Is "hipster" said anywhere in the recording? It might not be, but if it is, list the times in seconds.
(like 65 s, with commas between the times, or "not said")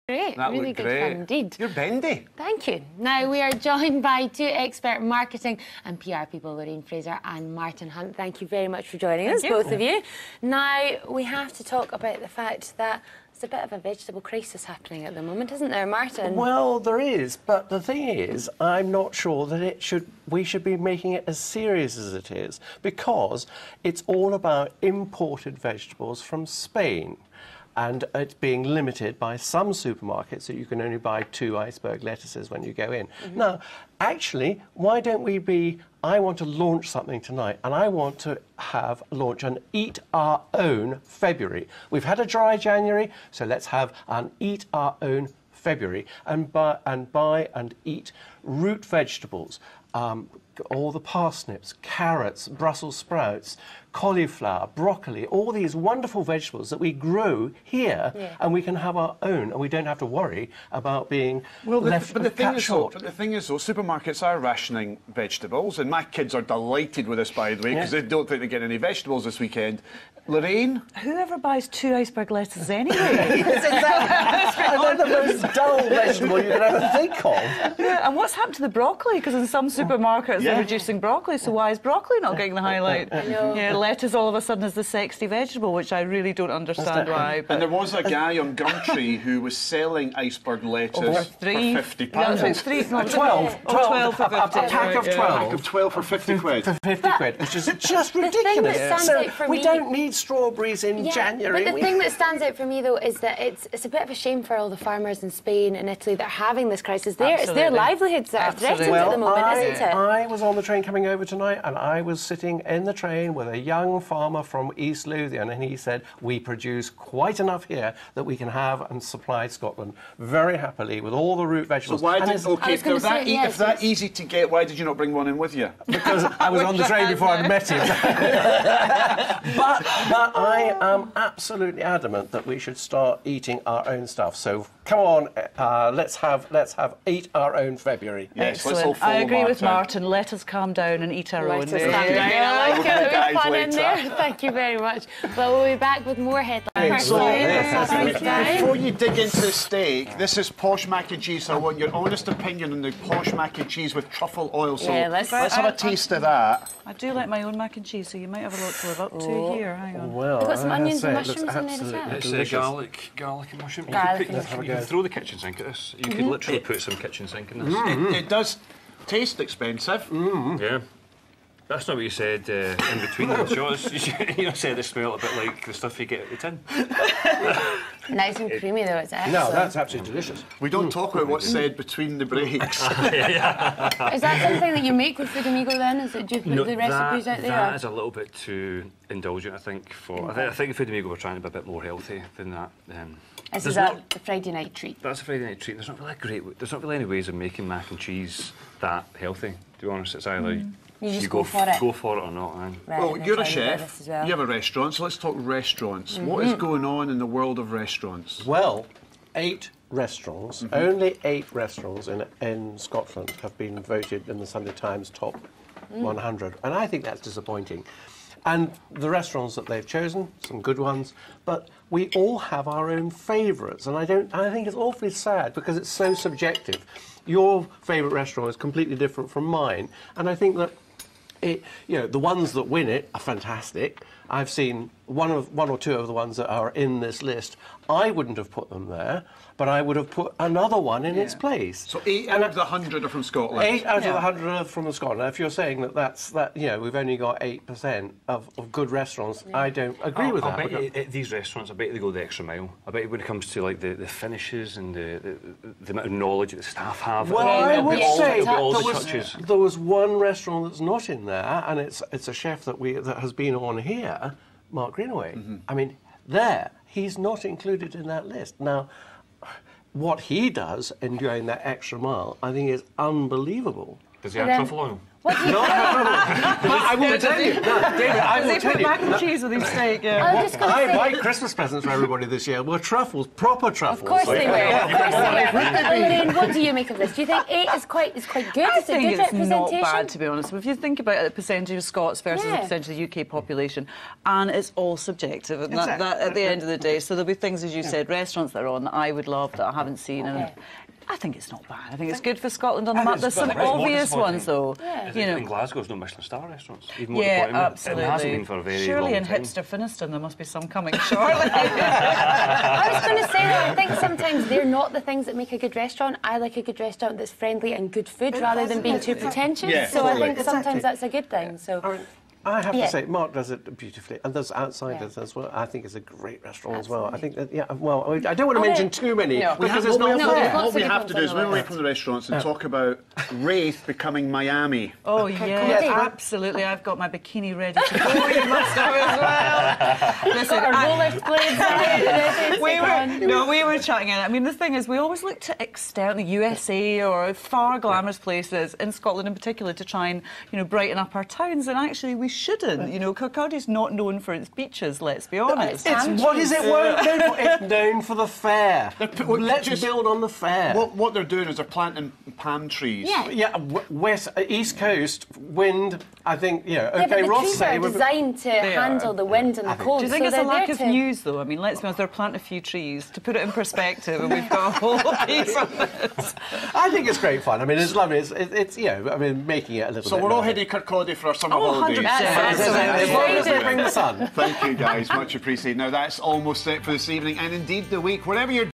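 309 s.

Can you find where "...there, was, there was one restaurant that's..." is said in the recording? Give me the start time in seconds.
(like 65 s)
259 s.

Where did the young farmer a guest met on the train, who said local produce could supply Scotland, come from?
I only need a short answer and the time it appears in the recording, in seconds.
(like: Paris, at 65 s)
East Lothian, at 114 s.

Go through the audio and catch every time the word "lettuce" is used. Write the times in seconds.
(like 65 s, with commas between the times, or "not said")
32 s, 72 s, 83 s, 90 s.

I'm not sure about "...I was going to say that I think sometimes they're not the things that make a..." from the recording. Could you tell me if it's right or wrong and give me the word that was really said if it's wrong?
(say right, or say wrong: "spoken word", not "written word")
right.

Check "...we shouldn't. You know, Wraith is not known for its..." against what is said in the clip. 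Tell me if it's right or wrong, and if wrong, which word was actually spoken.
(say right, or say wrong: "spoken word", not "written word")
wrong: "Kirkcaldy", not "Wraith".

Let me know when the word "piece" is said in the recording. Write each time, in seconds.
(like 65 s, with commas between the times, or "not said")
375 s.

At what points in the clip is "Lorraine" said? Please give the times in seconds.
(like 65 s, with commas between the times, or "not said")
6 s, 70 s.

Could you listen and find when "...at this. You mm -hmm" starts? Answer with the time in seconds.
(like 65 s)
165 s.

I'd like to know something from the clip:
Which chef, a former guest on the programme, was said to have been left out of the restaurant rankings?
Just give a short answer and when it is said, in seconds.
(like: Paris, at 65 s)
Mark Greenaway, at 264 s.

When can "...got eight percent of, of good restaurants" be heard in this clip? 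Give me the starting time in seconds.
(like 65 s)
247 s.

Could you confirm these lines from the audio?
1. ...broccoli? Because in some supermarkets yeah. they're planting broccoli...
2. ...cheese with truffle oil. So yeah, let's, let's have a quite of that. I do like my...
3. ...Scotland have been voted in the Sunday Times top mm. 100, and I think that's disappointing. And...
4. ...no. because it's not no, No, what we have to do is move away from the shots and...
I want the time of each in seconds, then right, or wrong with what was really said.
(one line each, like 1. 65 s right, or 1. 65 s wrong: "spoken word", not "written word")
1. 78 s wrong: "reducing", not "planting"
2. 153 s wrong: "taste", not "quite"
3. 212 s right
4. 329 s wrong: "restaurants", not "shots".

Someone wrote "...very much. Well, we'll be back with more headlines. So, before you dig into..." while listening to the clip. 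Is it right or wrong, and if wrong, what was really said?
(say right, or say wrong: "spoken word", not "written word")
right.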